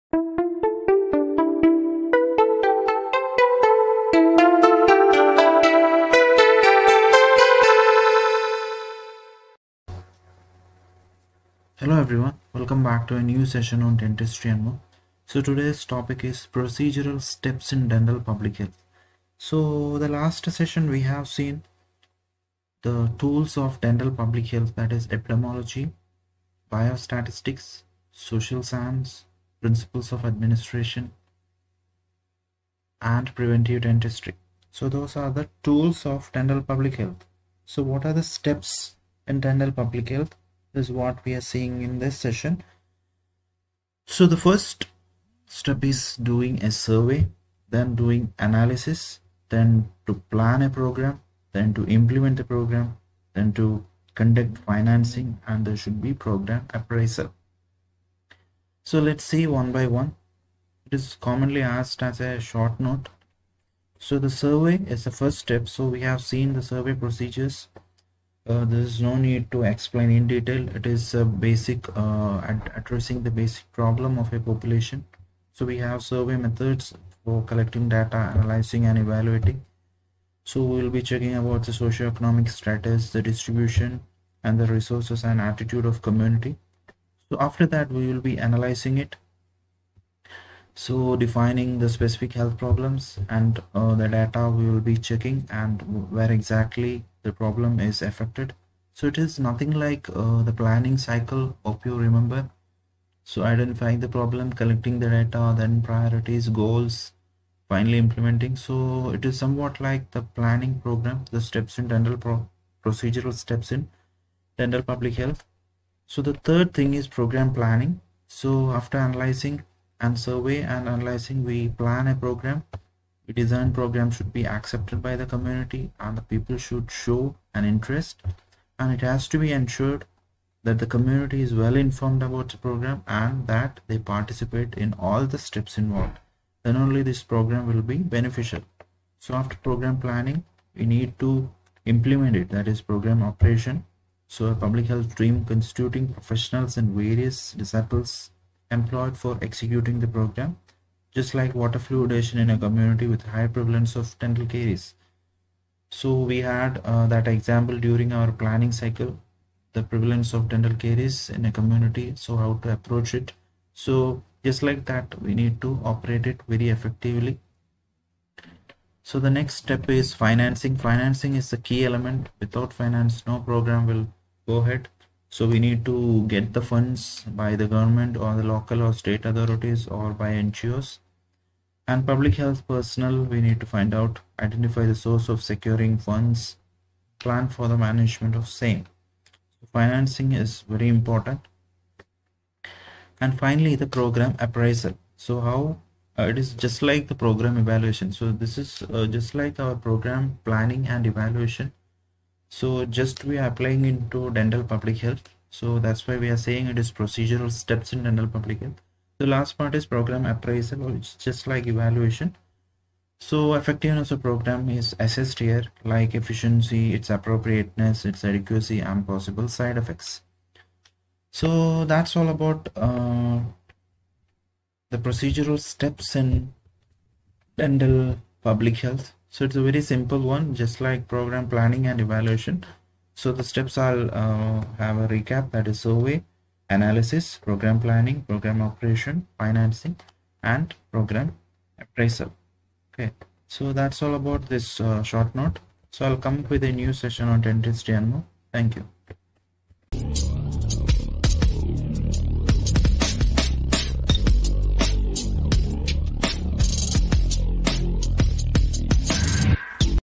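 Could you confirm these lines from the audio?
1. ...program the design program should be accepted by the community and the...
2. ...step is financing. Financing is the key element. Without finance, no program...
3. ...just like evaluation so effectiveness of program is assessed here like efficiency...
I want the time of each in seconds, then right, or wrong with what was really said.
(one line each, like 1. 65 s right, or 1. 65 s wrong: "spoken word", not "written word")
1. 122 s right
2. 169 s right
3. 211 s right.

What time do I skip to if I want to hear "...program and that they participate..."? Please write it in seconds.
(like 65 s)
132 s.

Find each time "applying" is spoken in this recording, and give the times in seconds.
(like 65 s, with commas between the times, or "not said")
203 s.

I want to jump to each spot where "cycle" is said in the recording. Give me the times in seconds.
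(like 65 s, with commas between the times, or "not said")
100 s, 158 s.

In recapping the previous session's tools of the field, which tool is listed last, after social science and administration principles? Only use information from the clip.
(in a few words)
Preventive dentistry.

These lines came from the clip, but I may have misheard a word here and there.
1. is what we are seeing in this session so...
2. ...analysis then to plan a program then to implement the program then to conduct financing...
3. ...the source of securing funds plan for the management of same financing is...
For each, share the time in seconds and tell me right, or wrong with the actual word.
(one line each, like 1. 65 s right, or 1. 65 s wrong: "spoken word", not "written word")
1. 40 s right
2. 48 s right
3. 184 s right.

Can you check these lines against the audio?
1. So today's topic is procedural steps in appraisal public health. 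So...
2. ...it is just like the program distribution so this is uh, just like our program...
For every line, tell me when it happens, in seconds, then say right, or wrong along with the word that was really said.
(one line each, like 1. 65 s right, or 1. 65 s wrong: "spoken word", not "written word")
1. 15 s wrong: "dental", not "appraisal"
2. 196 s wrong: "evaluation", not "distribution".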